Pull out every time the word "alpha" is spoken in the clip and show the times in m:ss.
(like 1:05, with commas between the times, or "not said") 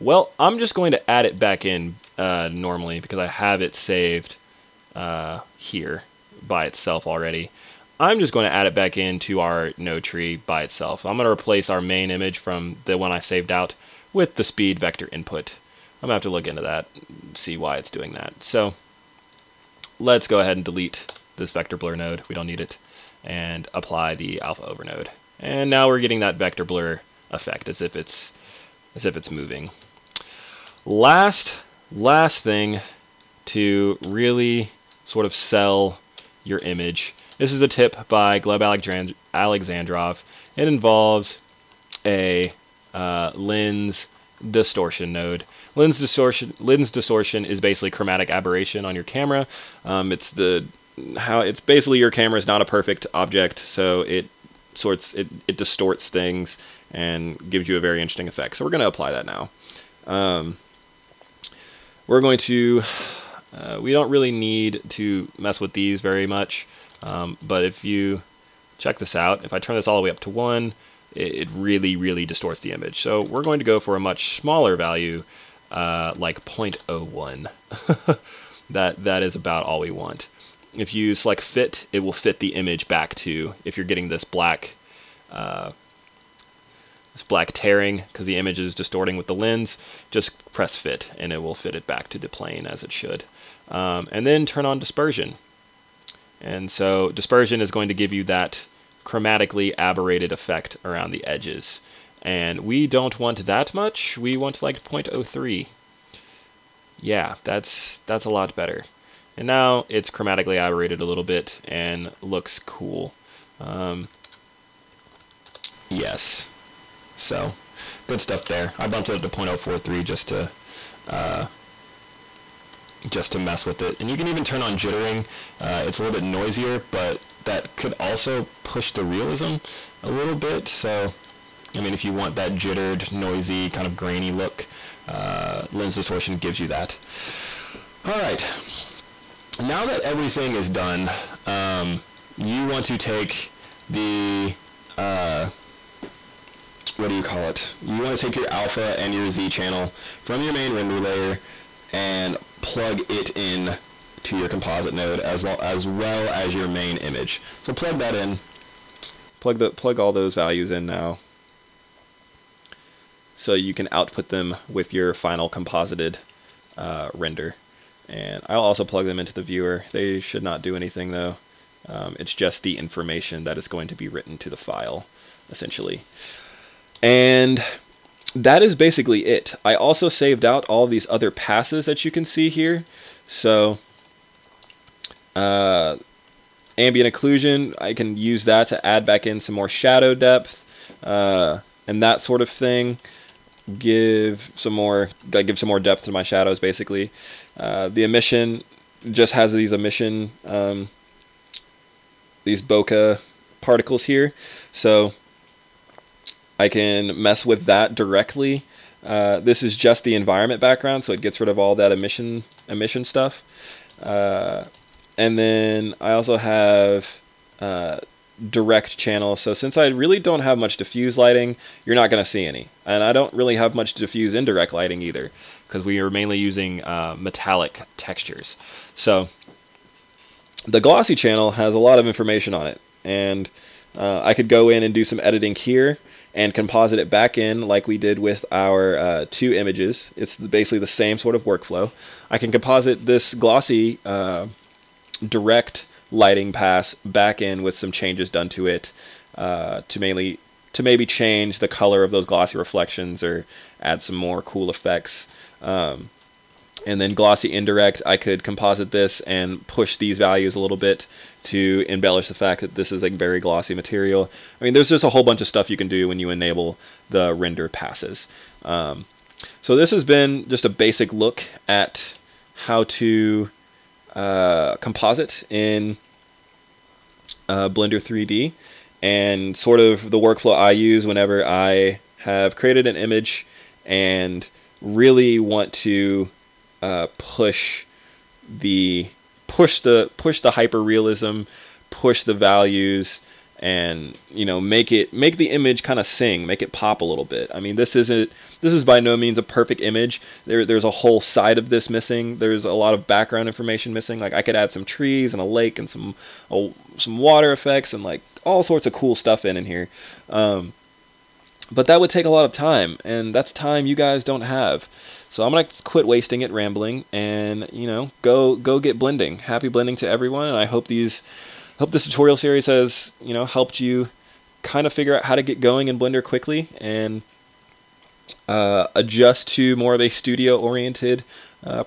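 0:24, 2:28.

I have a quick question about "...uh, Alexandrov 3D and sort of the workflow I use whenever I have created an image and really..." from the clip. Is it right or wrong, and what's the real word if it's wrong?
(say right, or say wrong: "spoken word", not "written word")
wrong: "Blender", not "Alexandrov".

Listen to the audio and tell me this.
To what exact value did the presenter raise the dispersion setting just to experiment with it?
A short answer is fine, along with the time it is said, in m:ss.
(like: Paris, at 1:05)
0.043, at 1:59.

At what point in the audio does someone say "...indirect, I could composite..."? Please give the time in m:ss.
4:17.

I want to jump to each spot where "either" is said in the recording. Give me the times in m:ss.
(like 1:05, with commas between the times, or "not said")
3:45.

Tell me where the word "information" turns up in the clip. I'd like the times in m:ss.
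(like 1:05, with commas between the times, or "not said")
2:52, 3:52, 5:03.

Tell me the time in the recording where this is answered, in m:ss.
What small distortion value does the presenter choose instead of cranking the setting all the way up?
1:16.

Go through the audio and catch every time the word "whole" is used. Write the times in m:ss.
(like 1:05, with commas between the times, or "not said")
4:25, 5:00.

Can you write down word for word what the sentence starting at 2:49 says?
They should not do anything though.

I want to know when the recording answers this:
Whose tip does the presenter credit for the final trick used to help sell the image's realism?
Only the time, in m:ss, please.
0:38.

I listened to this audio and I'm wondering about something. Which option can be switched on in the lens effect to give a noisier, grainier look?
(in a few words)
jittering.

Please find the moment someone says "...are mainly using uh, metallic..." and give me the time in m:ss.
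3:45.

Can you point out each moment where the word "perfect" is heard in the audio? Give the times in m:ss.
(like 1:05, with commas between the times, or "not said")
0:52, 4:59.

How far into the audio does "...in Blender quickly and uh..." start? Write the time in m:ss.
5:25.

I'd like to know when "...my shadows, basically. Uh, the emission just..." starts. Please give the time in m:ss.
3:16.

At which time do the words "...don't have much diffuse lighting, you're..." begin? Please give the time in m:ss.
3:40.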